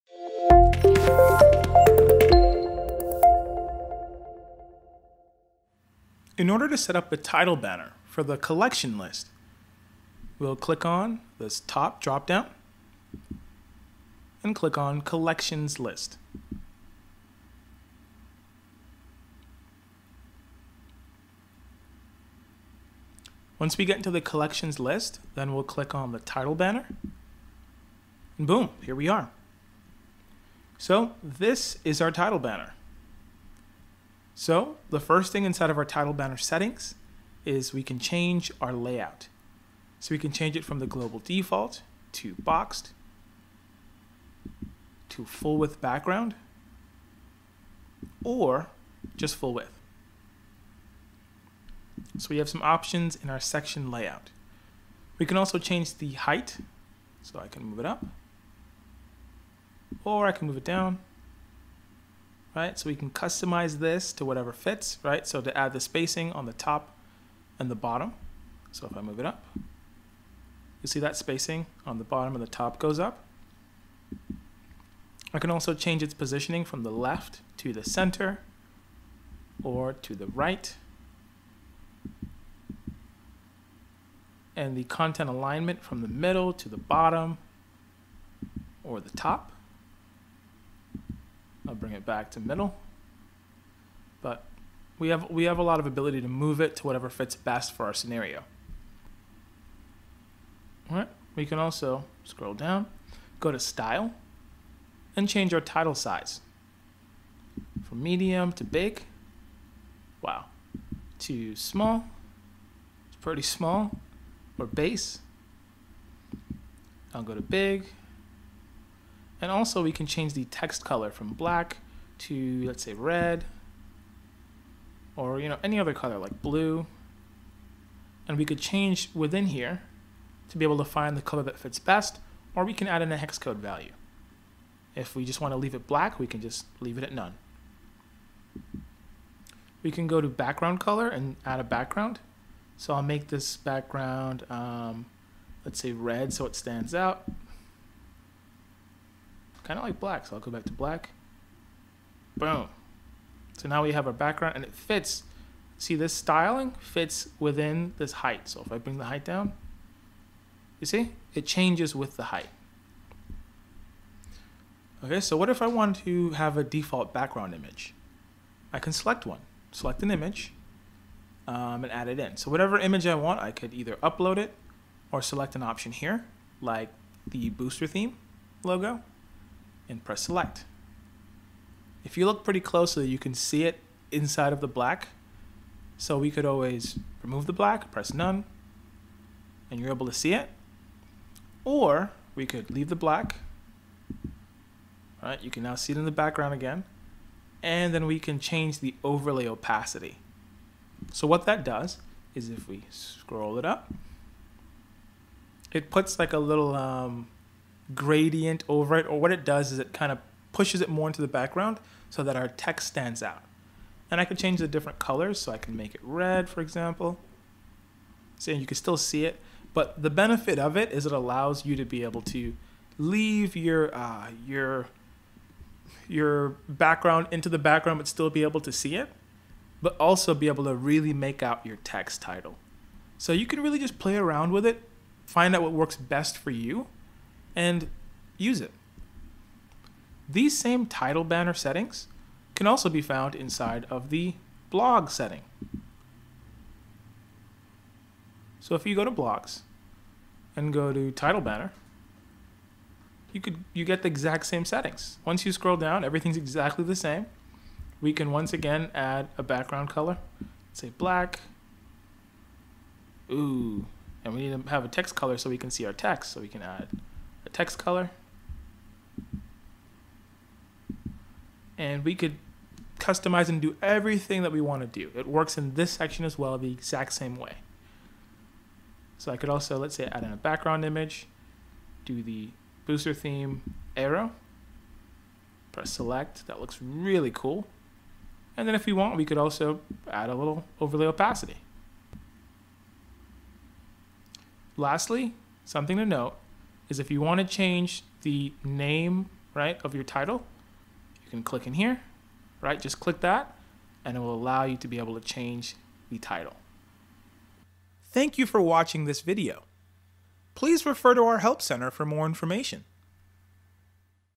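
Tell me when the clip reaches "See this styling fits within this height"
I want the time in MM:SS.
02:35.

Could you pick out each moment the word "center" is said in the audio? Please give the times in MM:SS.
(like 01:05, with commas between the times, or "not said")
01:17, 05:11.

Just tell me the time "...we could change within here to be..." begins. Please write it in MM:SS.
02:08.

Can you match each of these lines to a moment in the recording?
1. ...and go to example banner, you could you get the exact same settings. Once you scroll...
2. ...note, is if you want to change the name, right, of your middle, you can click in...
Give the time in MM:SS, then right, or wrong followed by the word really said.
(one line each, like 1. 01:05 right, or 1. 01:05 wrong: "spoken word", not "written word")
1. 04:10 wrong: "title", not "example"
2. 04:56 wrong: "title", not "middle".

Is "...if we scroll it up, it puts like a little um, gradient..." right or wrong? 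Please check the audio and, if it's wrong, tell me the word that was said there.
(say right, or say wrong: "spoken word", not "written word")
right.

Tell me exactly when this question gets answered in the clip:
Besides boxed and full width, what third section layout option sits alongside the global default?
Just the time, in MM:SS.
00:45.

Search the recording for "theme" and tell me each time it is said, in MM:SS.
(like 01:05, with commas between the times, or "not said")
02:57, 04:43.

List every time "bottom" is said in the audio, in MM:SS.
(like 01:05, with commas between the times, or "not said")
01:07, 01:12, 01:26.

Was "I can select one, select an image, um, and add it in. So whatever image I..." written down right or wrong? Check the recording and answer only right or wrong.
right.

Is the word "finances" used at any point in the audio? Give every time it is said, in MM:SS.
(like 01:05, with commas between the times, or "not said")
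not said.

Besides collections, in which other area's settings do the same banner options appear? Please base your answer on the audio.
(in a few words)
blog.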